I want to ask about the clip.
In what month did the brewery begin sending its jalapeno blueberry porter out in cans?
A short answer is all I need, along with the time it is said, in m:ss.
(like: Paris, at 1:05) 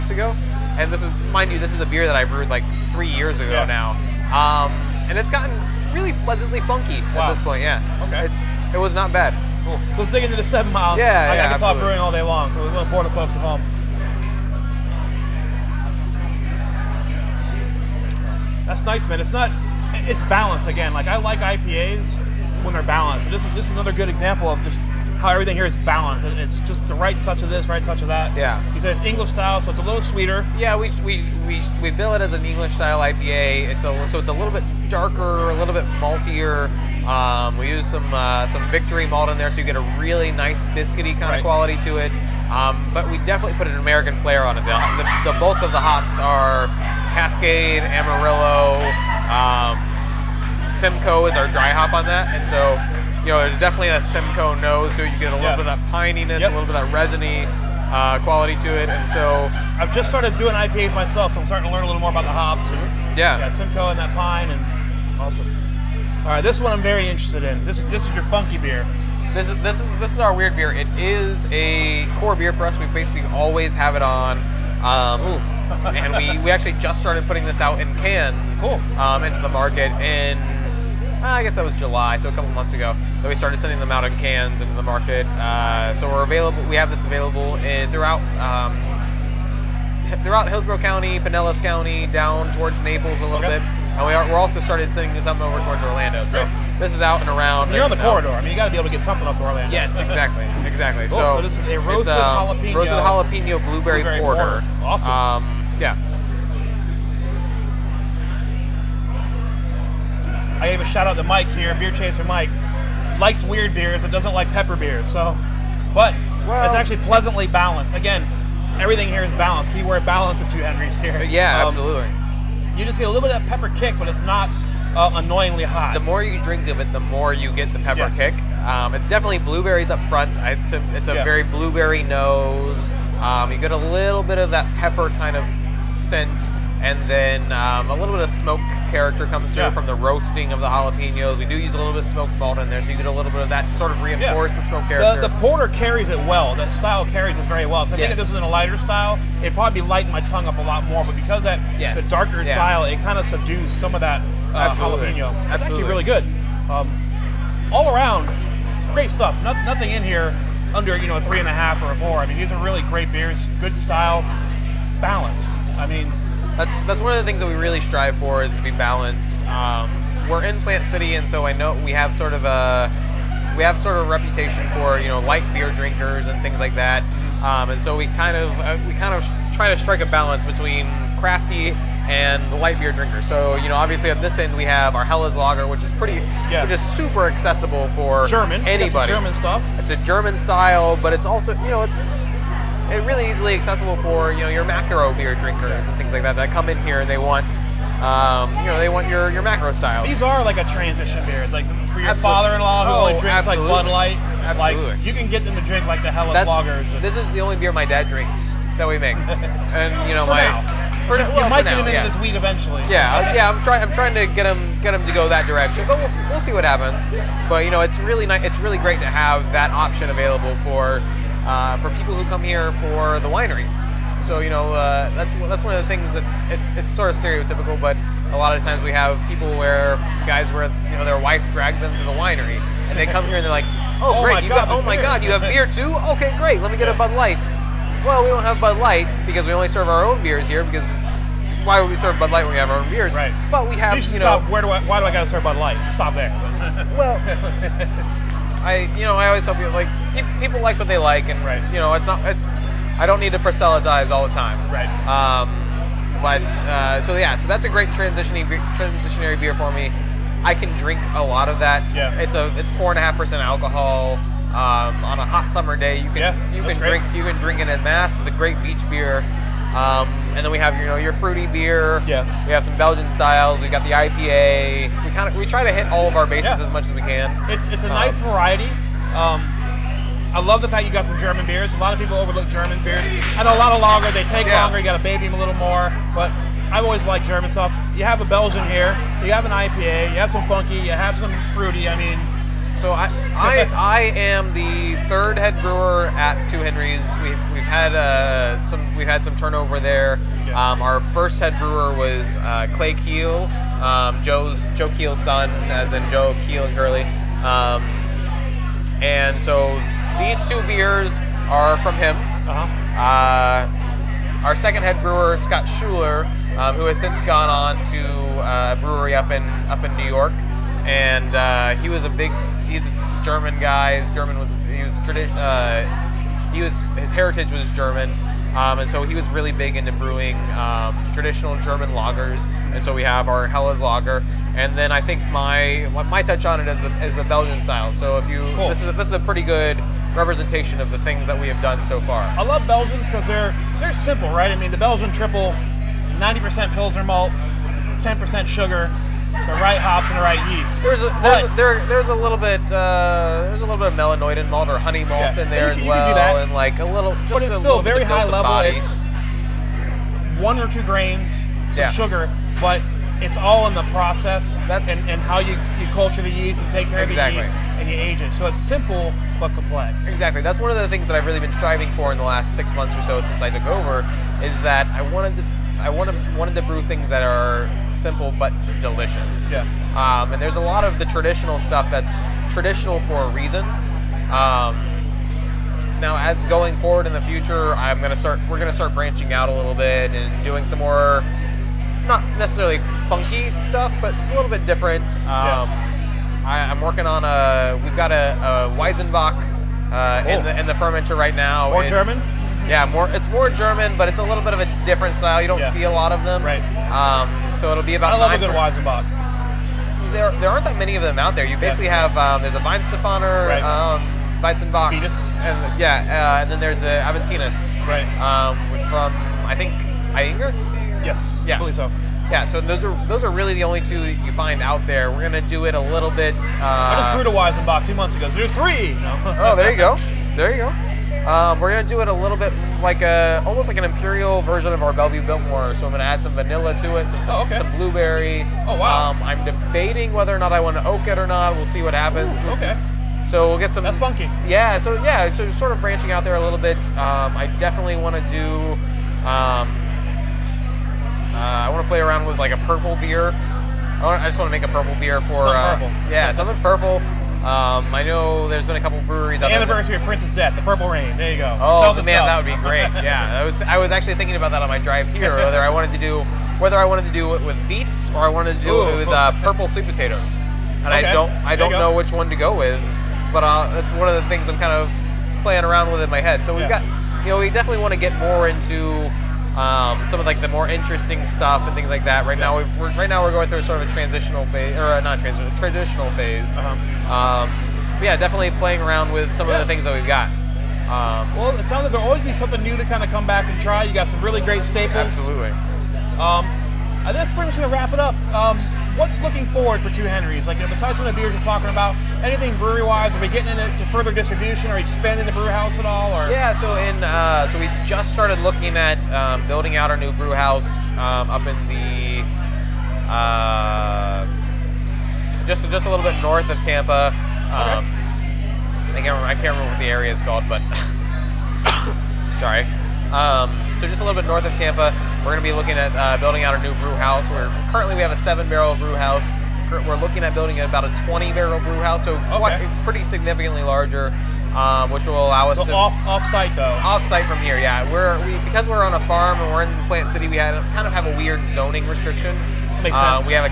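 July, at 1:21.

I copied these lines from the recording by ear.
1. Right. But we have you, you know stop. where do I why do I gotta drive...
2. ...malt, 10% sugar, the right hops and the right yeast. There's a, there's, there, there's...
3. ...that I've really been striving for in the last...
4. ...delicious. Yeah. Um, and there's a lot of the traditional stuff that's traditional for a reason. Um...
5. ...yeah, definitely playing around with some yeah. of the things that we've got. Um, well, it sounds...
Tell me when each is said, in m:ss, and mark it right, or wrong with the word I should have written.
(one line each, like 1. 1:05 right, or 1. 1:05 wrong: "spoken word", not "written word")
1. 4:03 wrong: "serve", not "drive"
2. 5:47 right
3. 6:11 right
4. 6:18 right
5. 8:08 right.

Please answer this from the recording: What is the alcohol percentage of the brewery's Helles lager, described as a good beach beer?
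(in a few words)
4.5%.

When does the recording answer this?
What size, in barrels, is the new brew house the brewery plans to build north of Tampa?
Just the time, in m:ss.
8:51.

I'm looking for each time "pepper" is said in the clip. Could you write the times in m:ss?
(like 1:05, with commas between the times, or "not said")
1:54, 2:03, 2:07, 2:14.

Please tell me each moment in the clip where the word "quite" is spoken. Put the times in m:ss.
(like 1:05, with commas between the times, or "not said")
8:52.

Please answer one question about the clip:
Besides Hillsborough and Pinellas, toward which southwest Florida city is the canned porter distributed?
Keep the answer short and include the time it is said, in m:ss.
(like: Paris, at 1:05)
Naples, at 1:32.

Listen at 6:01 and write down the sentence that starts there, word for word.
sugar, but it's all in the process That's, and, and how you, you culture the yeast and take care exactly.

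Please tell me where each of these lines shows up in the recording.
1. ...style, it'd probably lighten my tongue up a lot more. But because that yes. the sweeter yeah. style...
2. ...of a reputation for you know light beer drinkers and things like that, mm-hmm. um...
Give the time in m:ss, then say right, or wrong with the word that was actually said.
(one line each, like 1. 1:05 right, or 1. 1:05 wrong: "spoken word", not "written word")
1. 2:28 wrong: "darker", not "sweeter"
2. 2:53 right.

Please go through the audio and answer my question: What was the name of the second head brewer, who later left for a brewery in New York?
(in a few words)
Scott Schuler.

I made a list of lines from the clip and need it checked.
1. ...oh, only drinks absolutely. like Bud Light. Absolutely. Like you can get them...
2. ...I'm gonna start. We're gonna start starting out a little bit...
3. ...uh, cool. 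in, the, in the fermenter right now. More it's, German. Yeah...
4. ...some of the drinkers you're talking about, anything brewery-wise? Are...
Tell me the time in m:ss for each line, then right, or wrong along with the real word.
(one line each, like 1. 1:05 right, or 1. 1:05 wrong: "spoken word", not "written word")
1. 3:22 right
2. 6:27 wrong: "branching", not "starting"
3. 6:39 right
4. 8:20 wrong: "beers", not "drinkers".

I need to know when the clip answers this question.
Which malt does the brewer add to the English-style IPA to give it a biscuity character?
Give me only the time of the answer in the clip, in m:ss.
0:38.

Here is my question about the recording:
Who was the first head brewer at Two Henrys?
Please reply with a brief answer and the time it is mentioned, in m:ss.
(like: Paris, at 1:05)
Clay Keel, at 5:02.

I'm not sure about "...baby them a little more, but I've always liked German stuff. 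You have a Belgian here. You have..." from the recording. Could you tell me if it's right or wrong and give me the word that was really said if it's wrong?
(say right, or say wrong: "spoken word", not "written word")
right.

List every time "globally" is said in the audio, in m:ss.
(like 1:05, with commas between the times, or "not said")
not said.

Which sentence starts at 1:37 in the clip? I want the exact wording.
And you're and on the um, corridor.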